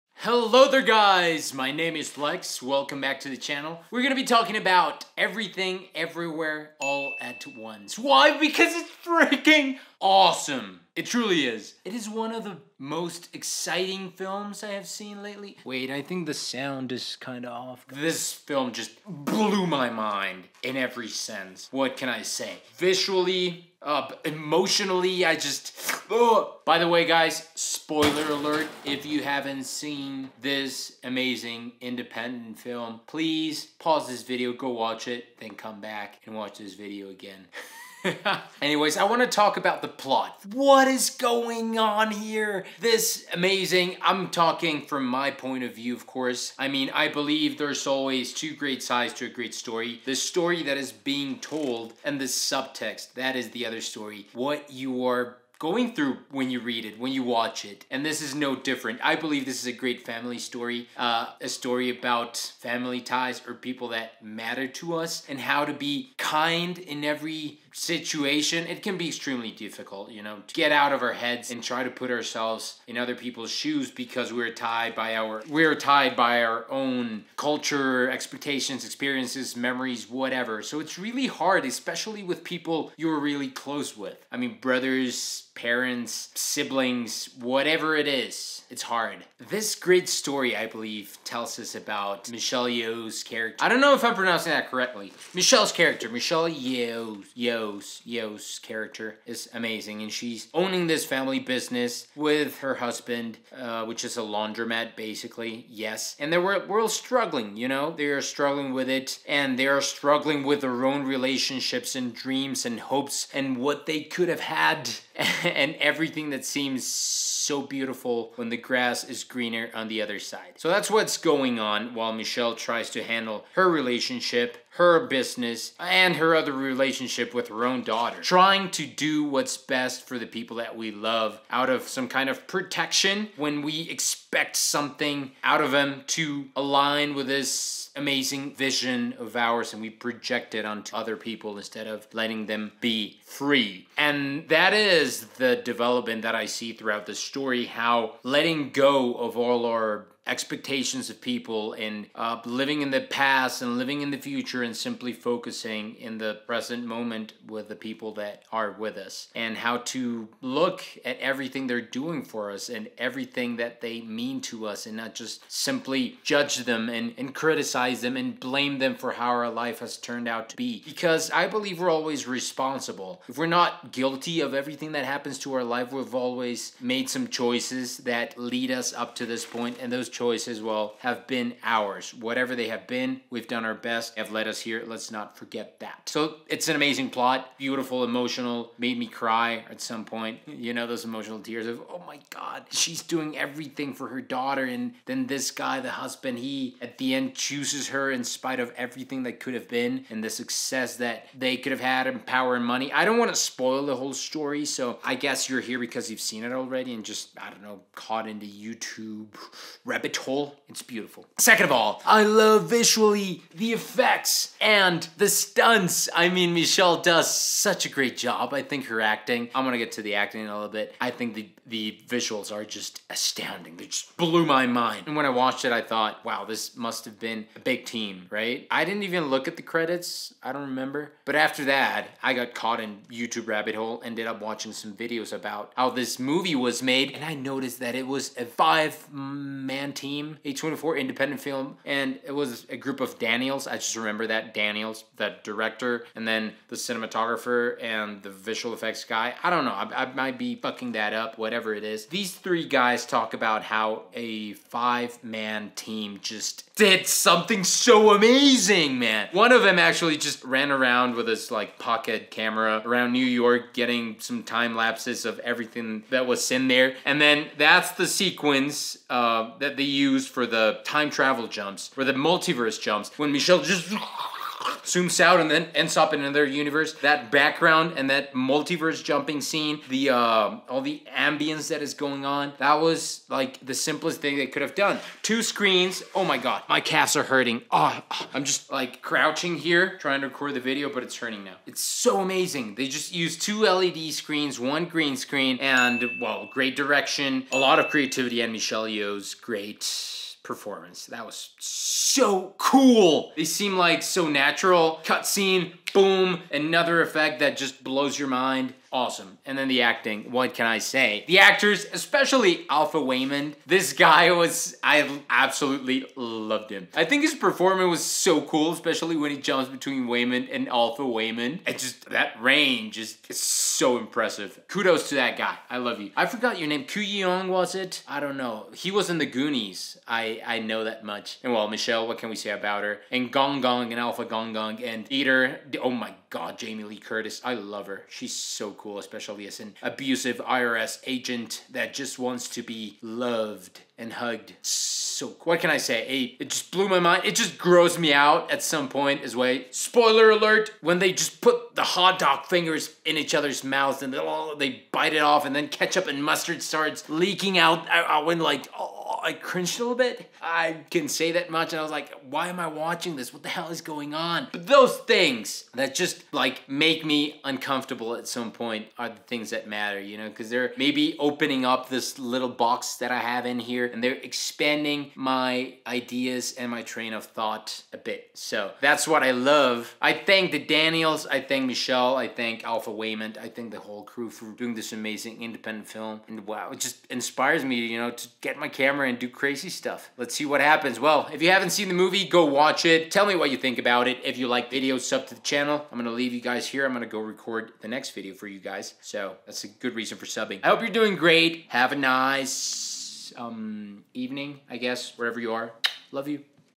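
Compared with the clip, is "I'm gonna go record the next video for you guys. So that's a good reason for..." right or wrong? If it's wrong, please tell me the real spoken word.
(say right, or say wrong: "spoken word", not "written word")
right.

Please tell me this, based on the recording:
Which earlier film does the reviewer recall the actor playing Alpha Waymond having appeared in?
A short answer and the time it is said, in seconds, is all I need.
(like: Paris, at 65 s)
The Goonies, at 329 s.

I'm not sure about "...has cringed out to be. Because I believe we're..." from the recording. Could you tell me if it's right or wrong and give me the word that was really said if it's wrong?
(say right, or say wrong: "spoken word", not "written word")
wrong: "turned", not "cringed".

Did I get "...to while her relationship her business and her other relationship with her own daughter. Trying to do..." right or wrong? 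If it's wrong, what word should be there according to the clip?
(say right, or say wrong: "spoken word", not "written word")
wrong: "handle", not "while".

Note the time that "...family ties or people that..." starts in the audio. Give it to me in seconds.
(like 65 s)
62 s.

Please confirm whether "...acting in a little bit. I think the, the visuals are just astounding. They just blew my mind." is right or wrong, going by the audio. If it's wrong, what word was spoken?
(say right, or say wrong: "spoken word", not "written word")
right.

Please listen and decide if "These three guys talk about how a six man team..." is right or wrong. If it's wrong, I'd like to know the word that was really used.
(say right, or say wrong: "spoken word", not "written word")
wrong: "five", not "six".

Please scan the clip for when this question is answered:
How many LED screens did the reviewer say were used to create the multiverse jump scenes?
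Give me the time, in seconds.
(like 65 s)
293 s.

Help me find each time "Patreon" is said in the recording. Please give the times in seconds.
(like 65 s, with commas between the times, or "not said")
not said.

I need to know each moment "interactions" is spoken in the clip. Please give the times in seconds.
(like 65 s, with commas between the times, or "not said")
not said.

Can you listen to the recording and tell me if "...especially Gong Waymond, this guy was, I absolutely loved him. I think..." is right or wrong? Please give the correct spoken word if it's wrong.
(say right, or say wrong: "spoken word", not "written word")
wrong: "Alpha", not "Gong".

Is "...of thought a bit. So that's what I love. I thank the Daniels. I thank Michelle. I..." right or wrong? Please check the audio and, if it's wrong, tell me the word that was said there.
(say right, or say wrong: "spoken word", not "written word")
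right.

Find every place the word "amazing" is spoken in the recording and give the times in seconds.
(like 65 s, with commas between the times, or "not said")
31 s, 43 s, 99 s, 137 s, 186 s, 258 s, 292 s, 384 s.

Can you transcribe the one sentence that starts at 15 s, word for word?
Wait, I think the sound is kind of off.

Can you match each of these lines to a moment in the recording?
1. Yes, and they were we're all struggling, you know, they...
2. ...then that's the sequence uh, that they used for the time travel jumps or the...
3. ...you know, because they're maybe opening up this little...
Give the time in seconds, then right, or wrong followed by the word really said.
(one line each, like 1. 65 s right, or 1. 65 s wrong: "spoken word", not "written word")
1. 105 s right
2. 267 s right
3. 369 s right.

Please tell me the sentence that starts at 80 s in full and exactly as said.
So it's really hard, especially with people you're really close with.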